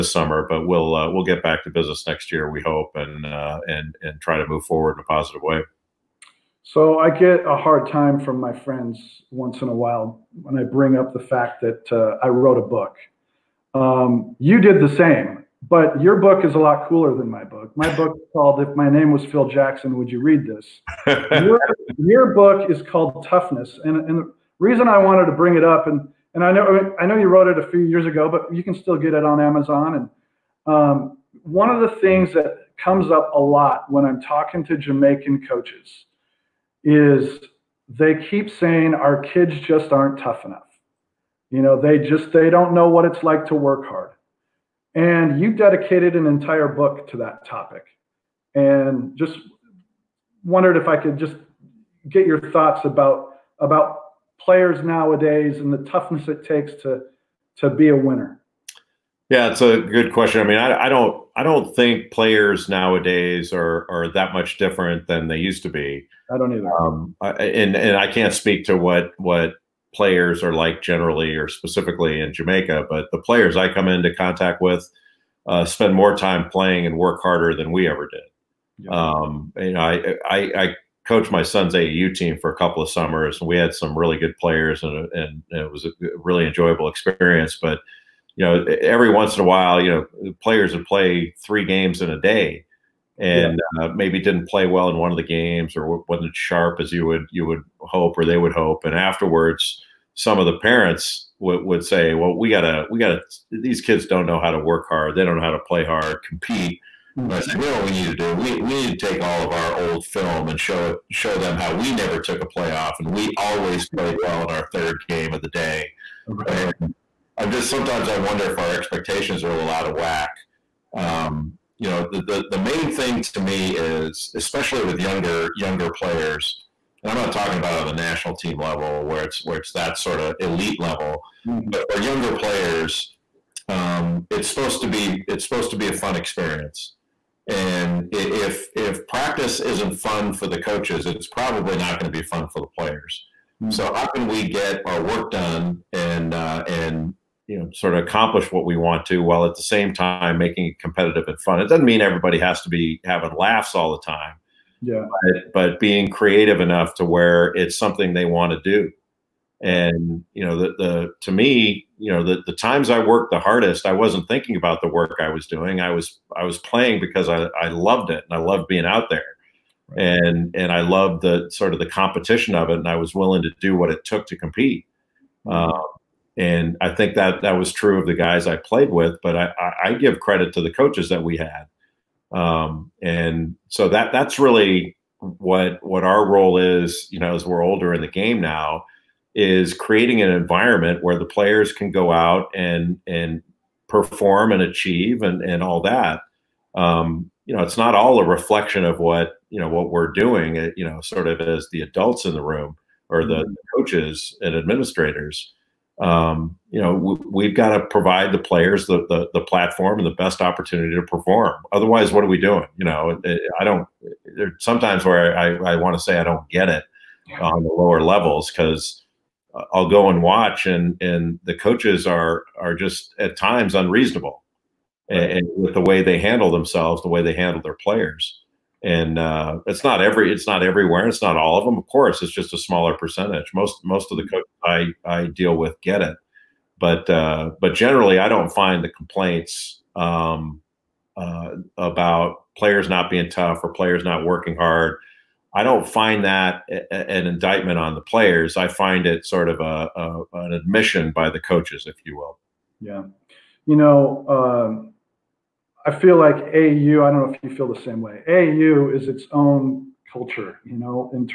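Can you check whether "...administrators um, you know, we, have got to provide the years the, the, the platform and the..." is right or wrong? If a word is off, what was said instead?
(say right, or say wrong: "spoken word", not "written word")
wrong: "players", not "years".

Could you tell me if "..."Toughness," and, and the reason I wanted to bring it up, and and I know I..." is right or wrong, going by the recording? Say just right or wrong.
right.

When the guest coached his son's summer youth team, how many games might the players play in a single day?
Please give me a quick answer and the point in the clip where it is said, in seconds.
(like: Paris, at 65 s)
3, at 91 s.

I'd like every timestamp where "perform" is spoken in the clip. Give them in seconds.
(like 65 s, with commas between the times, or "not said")
193 s, 211 s.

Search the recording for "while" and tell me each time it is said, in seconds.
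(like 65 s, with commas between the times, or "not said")
9 s, 89 s, 149 s.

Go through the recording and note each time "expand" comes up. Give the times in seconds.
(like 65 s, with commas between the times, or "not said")
not said.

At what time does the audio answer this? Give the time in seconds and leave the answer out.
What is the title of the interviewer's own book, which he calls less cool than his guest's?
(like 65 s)
18 s.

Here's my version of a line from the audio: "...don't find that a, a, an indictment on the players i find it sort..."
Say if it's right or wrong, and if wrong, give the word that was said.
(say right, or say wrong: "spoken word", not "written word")
right.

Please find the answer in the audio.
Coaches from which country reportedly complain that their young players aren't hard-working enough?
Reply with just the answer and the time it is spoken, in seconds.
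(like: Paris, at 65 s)
Jamaica, at 34 s.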